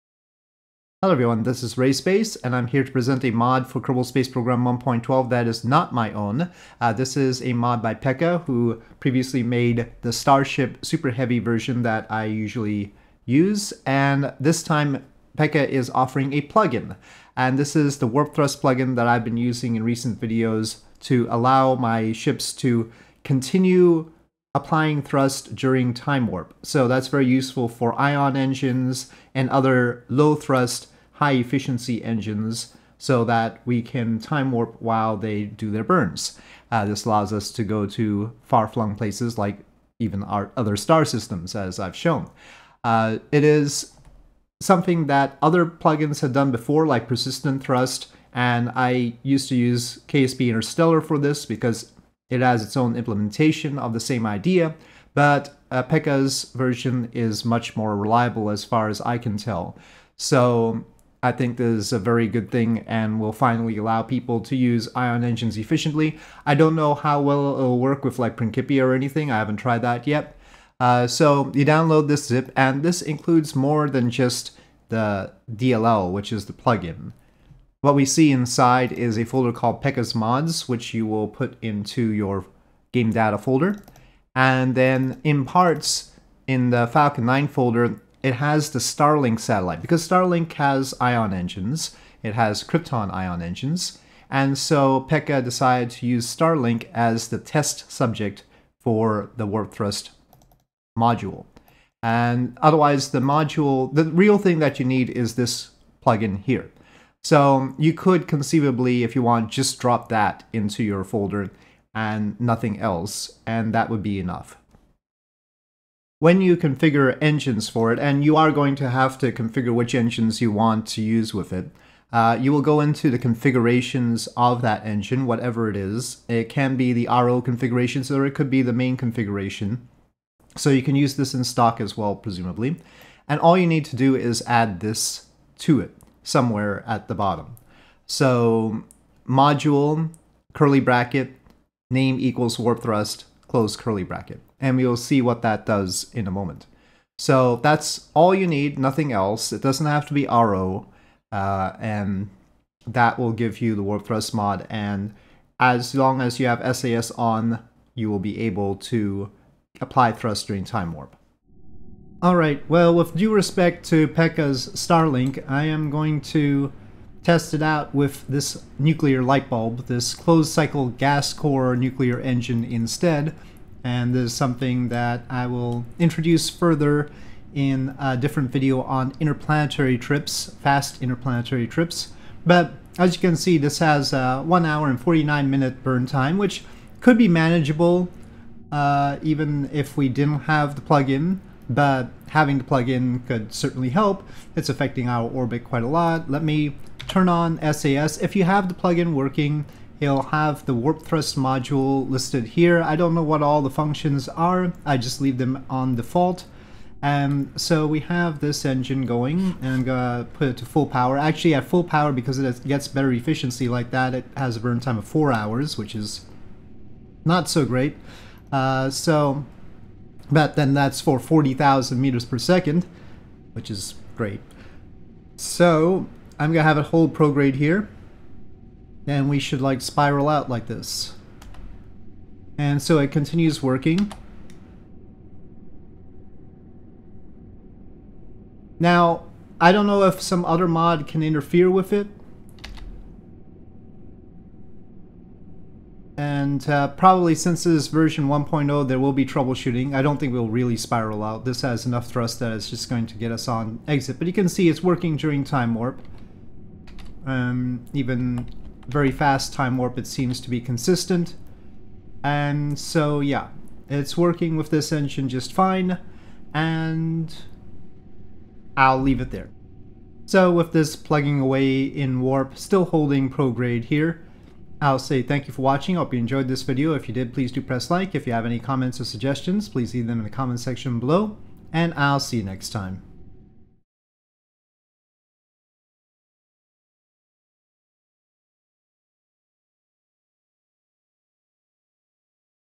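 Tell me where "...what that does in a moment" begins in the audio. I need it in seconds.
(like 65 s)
145 s.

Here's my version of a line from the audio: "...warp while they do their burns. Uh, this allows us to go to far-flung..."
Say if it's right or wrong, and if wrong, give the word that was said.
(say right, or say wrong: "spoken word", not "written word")
right.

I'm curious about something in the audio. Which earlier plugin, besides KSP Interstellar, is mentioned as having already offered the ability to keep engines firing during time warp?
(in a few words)
Persistent Thrust.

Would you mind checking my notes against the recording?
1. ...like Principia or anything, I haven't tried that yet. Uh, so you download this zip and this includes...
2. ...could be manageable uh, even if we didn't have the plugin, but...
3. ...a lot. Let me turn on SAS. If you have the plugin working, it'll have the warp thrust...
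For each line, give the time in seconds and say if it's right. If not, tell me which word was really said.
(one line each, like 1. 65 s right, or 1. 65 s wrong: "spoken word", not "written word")
1. 68 s right
2. 187 s right
3. 195 s right.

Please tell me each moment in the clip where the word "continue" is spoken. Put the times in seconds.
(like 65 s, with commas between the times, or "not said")
23 s, 233 s.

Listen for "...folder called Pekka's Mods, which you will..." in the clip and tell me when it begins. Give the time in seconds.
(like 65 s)
79 s.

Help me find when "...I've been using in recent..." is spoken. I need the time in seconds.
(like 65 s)
19 s.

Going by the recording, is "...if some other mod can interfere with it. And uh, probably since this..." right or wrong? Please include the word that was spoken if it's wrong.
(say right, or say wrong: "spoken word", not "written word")
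right.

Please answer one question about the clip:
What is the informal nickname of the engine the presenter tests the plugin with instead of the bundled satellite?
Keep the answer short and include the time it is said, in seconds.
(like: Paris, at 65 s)
nuclear light bulb, at 168 s.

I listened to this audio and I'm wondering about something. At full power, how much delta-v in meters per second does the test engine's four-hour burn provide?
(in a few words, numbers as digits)
40,000.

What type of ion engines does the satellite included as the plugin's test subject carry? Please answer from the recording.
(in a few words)
Krypton.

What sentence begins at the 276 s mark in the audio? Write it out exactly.
If you did, please do press like.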